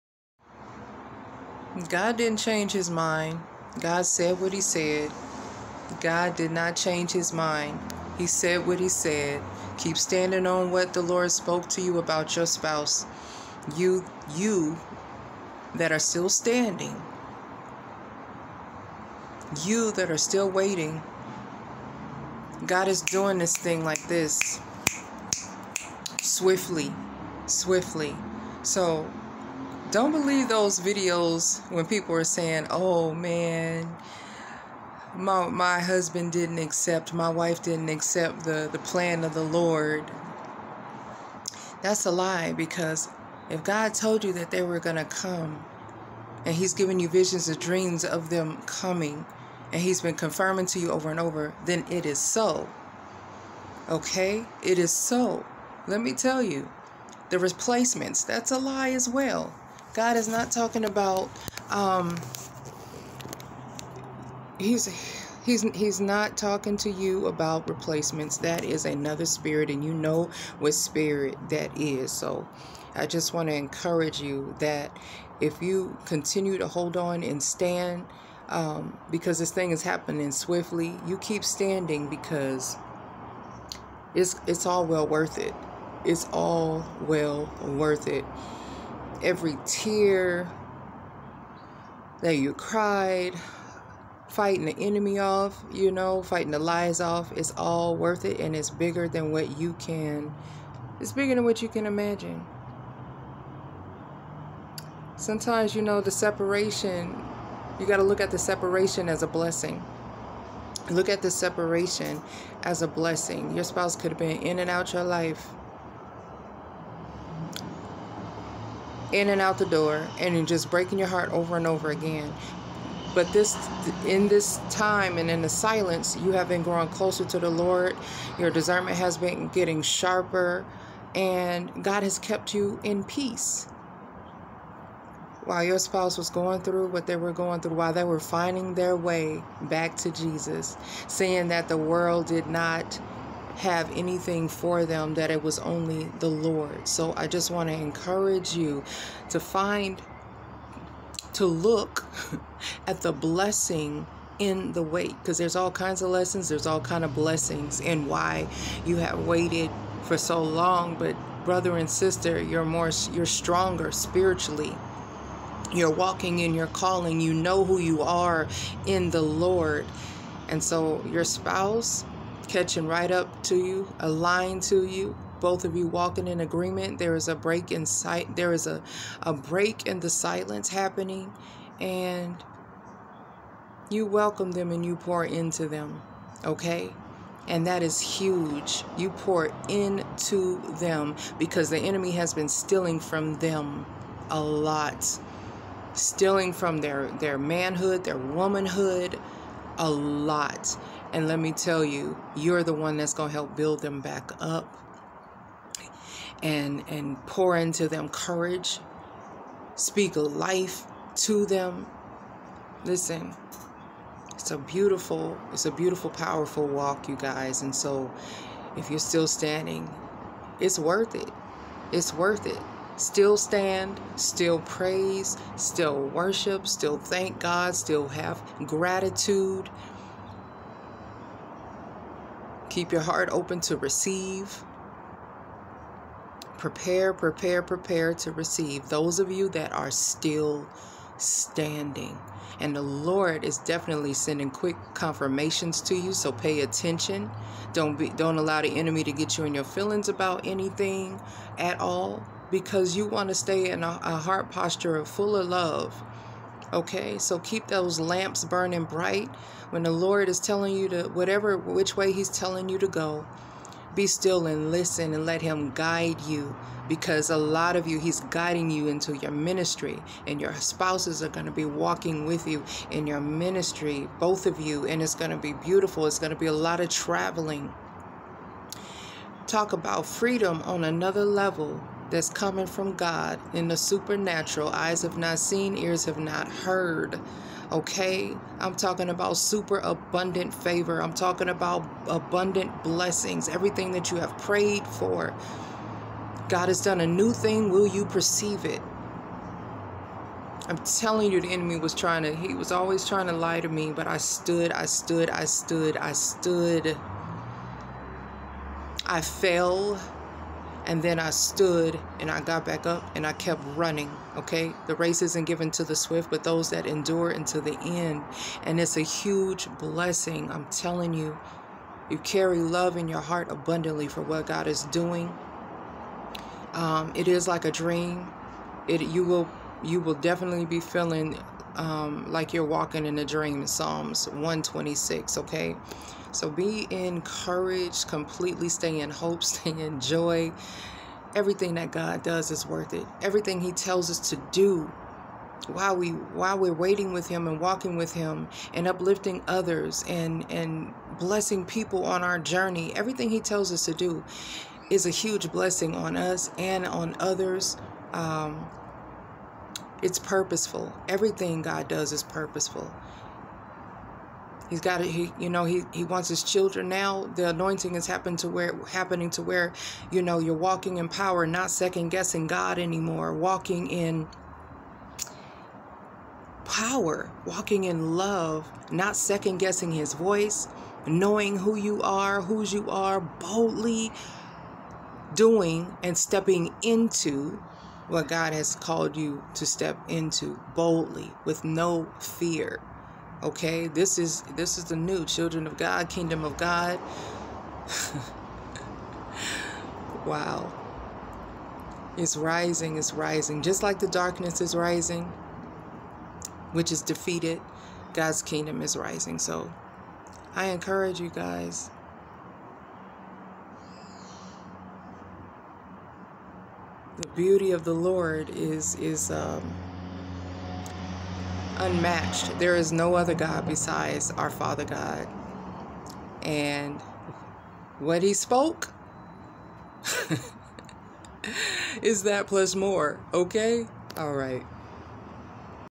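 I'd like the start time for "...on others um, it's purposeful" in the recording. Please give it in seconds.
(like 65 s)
356 s.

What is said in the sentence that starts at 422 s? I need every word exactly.
There is no other God besides our Father God.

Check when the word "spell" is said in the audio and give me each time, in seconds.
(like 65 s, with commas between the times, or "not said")
not said.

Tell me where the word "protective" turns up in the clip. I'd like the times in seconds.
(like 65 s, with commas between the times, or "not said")
not said.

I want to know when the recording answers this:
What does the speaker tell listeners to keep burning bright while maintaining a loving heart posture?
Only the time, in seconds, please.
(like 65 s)
257 s.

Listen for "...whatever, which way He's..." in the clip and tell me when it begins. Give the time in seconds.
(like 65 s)
261 s.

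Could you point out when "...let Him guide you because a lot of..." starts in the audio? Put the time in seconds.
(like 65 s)
265 s.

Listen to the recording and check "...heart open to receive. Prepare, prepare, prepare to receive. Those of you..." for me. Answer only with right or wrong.
right.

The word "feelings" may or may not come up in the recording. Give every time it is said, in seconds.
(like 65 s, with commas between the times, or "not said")
249 s, 330 s.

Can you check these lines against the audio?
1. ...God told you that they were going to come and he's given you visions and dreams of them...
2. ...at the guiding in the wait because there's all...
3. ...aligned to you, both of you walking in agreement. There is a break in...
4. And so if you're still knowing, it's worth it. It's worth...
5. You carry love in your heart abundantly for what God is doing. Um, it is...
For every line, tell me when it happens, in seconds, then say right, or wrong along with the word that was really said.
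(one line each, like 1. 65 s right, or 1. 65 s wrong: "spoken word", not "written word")
1. 43 s right
2. 152 s wrong: "blessing", not "guiding"
3. 173 s right
4. 217 s wrong: "standing", not "knowing"
5. 322 s right.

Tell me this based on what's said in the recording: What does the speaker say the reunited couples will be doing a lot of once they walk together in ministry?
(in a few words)
traveling.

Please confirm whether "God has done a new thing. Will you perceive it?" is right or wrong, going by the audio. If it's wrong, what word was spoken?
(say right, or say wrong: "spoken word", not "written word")
right.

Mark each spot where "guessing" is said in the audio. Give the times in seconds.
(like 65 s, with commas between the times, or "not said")
372 s, 379 s.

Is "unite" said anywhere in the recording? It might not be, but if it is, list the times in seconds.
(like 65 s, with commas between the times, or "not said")
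not said.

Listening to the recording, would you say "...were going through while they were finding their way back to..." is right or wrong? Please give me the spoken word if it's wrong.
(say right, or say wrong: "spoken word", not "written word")
right.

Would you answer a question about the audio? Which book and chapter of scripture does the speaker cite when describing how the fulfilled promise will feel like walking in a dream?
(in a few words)
Psalms 126.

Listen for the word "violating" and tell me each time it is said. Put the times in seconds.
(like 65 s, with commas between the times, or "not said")
not said.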